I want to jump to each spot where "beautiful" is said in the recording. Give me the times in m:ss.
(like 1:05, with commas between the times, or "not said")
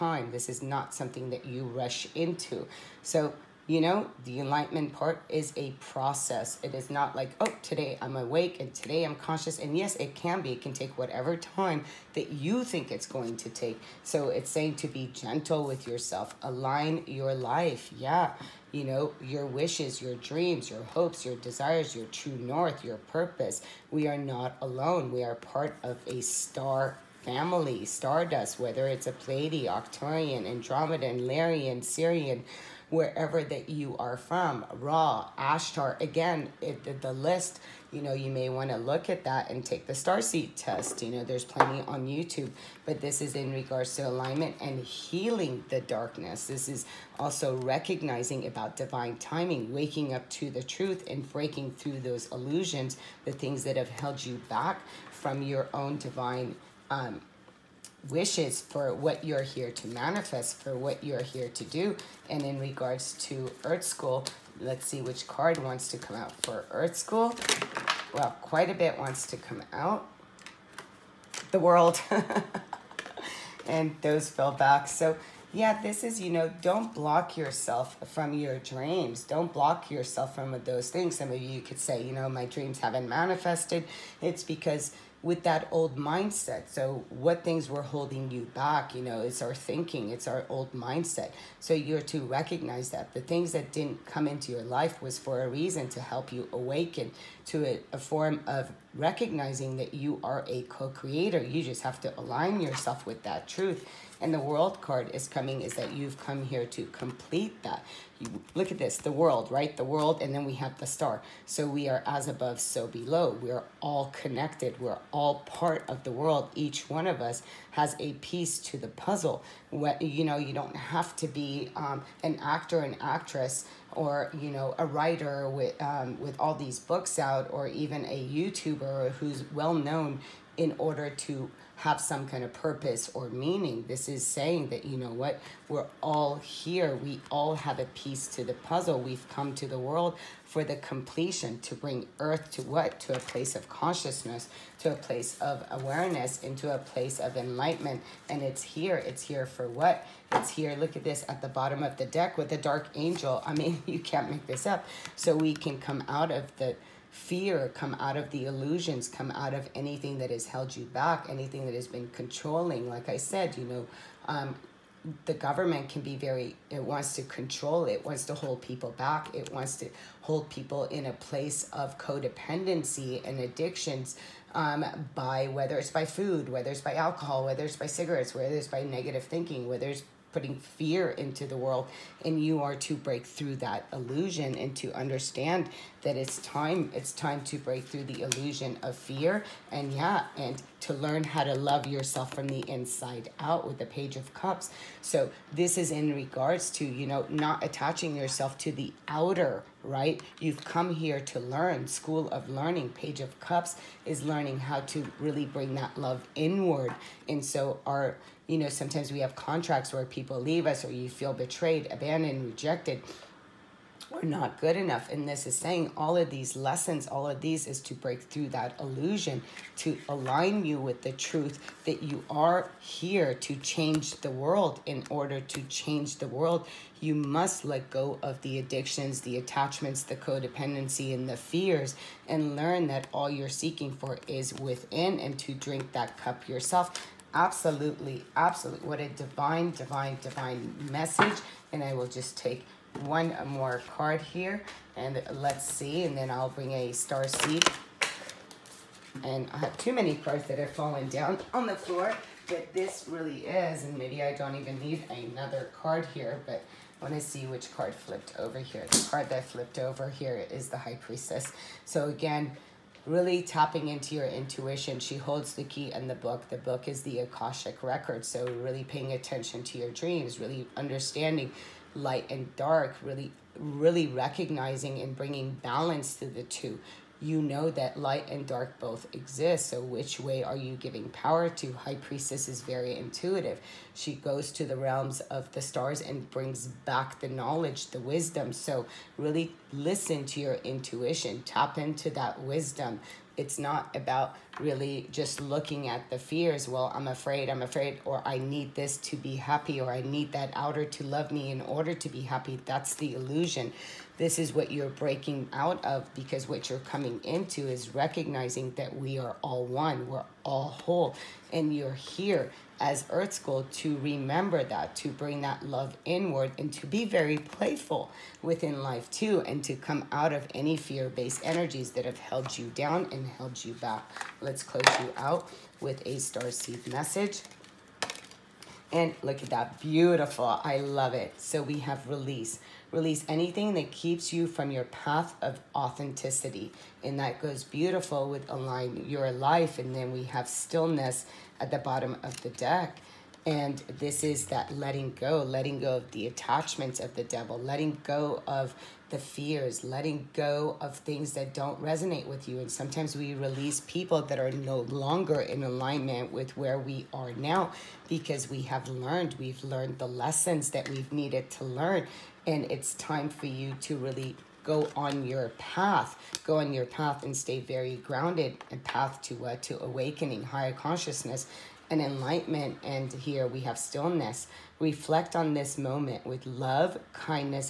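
5:29, 5:37.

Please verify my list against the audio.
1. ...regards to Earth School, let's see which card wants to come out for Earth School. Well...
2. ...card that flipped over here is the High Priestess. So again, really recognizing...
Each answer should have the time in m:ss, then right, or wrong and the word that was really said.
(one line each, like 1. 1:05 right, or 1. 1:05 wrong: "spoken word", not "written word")
1. 1:02 right
2. 4:19 wrong: "tapping", not "recognizing".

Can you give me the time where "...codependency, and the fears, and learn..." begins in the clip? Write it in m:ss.
3:50.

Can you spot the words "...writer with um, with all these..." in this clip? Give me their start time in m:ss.
2:04.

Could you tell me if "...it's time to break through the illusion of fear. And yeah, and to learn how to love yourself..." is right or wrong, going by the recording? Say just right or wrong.
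right.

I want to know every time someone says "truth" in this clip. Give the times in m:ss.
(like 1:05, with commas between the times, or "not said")
0:50, 1:43, 3:41.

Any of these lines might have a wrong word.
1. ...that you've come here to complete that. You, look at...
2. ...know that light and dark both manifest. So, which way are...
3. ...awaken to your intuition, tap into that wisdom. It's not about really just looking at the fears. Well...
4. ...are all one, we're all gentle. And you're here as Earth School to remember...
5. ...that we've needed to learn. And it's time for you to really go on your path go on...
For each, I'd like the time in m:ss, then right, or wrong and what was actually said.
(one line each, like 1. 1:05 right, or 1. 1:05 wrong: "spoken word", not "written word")
1. 1:45 right
2. 4:37 wrong: "exist", not "manifest"
3. 4:49 wrong: "listen", not "awaken"
4. 5:09 wrong: "whole", not "gentle"
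5. 6:00 right.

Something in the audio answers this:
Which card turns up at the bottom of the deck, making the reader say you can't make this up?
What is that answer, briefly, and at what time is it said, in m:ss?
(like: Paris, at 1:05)
Dark angel, at 2:32.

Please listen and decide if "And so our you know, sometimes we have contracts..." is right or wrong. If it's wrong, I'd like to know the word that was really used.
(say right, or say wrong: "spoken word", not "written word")
right.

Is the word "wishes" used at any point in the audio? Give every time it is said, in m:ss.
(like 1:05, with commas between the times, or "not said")
0:19, 0:58.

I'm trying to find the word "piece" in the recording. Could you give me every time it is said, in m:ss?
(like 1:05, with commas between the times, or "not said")
1:58, 2:17.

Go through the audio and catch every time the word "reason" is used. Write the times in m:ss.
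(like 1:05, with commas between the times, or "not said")
1:35.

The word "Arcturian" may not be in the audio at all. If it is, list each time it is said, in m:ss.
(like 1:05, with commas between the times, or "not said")
0:29.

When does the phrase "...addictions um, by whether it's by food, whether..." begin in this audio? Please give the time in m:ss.
2:53.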